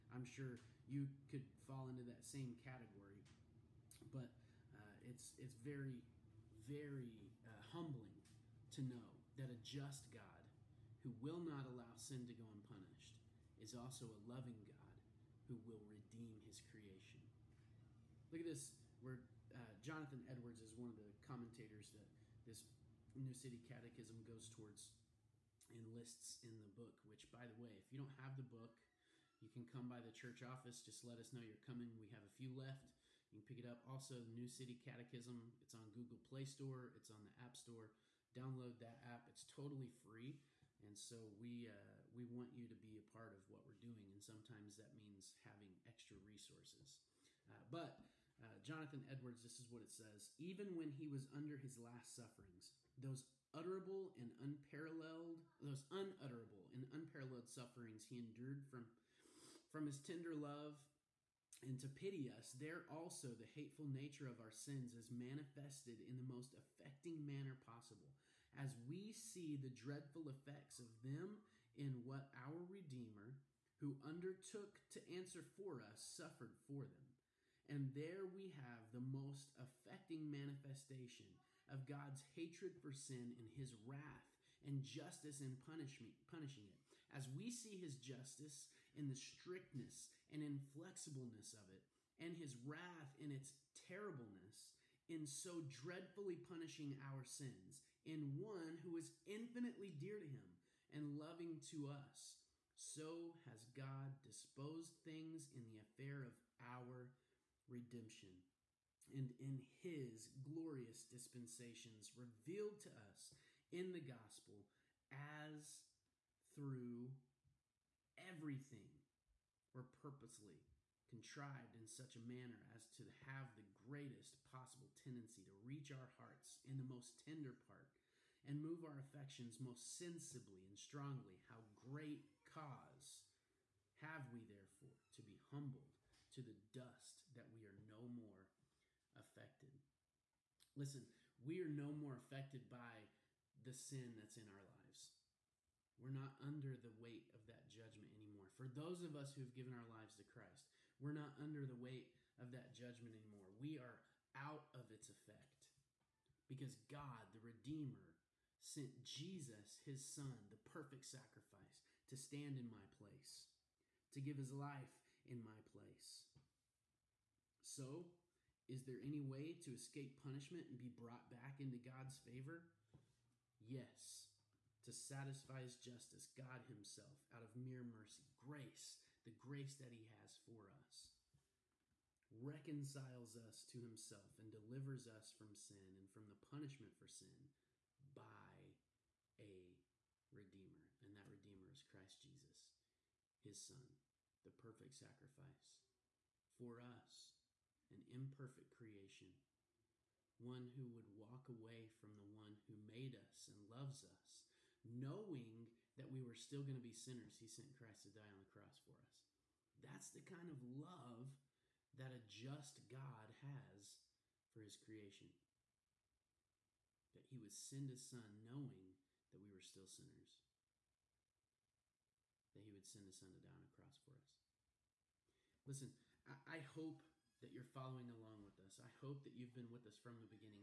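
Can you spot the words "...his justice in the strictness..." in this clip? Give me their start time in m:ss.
1:27.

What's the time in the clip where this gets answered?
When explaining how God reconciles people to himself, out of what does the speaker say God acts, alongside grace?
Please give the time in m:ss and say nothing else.
2:57.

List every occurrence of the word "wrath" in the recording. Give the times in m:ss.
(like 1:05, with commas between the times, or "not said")
1:23, 1:32.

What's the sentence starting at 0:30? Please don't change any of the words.
Just let us know you're coming.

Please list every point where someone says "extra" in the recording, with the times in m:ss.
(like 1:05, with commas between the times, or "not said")
0:45.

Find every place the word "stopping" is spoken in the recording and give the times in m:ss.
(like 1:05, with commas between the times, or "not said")
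not said.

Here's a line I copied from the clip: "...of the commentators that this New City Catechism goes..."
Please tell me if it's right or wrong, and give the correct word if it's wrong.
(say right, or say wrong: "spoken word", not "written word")
right.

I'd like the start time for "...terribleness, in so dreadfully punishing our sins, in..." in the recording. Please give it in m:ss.
1:33.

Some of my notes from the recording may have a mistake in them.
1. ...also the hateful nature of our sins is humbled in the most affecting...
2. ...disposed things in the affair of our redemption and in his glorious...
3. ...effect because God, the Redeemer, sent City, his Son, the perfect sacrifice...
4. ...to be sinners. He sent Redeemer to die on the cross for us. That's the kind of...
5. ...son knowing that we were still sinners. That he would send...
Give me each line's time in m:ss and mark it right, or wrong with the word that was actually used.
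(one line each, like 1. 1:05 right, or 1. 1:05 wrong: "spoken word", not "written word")
1. 1:02 wrong: "manifested", not "humbled"
2. 1:44 right
3. 2:35 wrong: "Jesus", not "City"
4. 3:26 wrong: "Christ", not "Redeemer"
5. 3:38 right.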